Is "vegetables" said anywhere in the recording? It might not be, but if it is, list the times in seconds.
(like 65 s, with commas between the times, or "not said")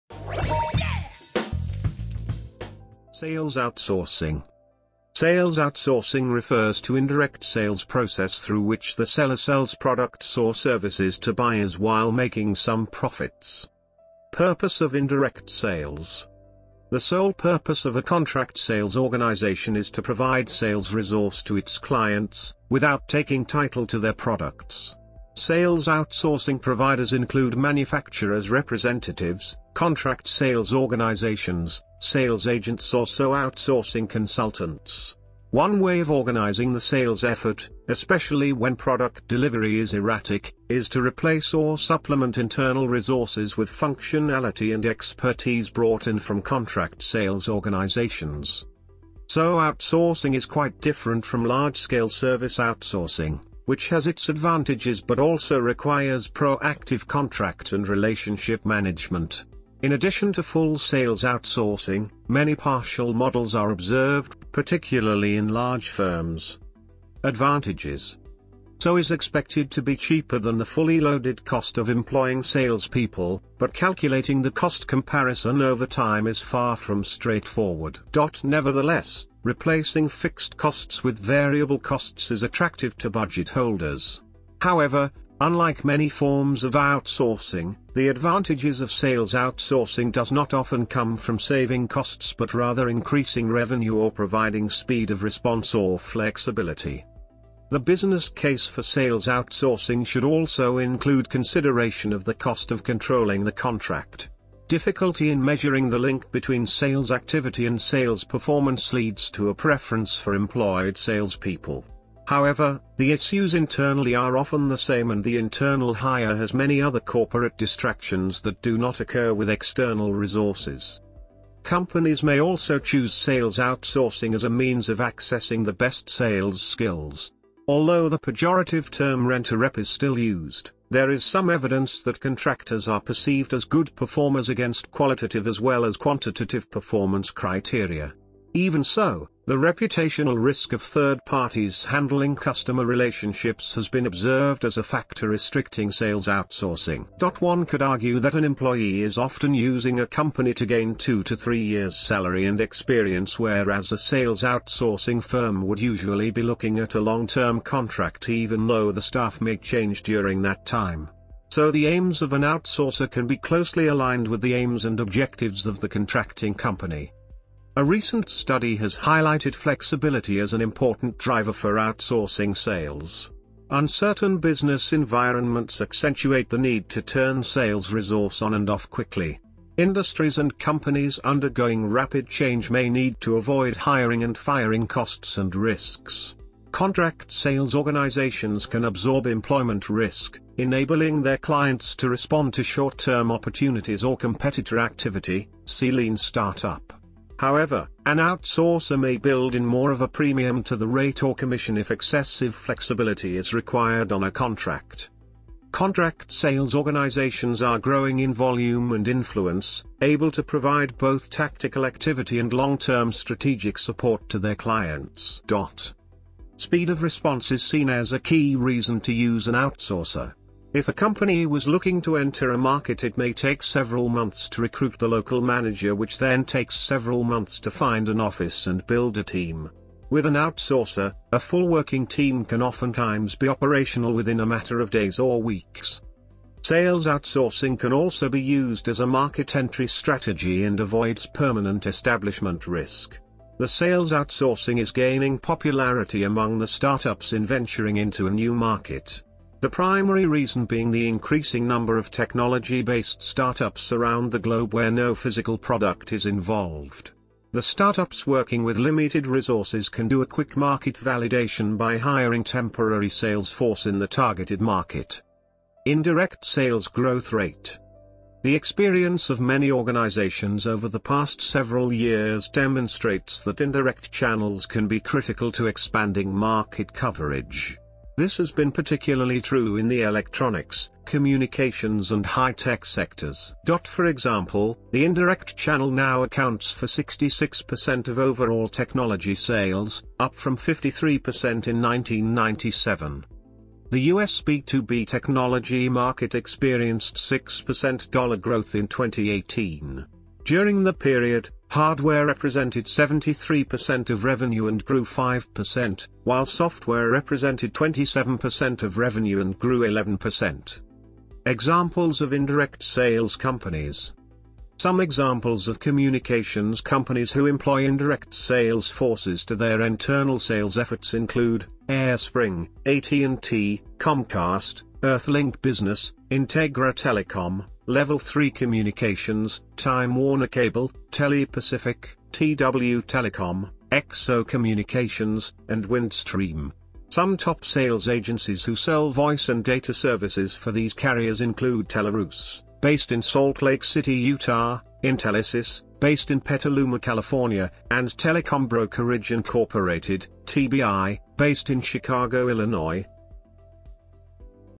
not said.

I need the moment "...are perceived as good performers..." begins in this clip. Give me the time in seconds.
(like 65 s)
132 s.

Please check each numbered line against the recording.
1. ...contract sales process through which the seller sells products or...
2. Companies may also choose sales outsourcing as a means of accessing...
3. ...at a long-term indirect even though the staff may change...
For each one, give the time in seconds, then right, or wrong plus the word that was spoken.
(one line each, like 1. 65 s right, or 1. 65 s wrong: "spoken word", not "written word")
1. 6 s wrong: "indirect", not "contract"
2. 121 s right
3. 156 s wrong: "contract", not "indirect".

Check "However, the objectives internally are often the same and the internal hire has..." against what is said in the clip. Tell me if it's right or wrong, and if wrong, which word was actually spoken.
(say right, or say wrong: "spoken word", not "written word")
wrong: "issues", not "objectives".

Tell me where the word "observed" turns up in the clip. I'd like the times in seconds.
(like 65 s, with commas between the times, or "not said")
63 s, 144 s.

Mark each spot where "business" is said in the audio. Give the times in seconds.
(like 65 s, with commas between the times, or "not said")
97 s, 174 s, 325 s.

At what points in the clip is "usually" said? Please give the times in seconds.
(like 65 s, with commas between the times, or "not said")
155 s.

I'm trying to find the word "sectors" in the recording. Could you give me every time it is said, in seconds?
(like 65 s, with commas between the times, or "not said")
282 s.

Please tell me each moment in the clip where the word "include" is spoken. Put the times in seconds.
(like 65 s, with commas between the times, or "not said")
27 s, 100 s, 321 s, 341 s.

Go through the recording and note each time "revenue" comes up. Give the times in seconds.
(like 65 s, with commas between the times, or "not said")
93 s, 304 s, 308 s.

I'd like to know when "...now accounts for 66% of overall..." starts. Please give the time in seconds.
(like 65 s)
285 s.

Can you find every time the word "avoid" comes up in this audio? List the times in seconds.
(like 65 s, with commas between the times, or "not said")
183 s, 240 s.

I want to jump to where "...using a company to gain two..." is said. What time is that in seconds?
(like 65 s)
149 s.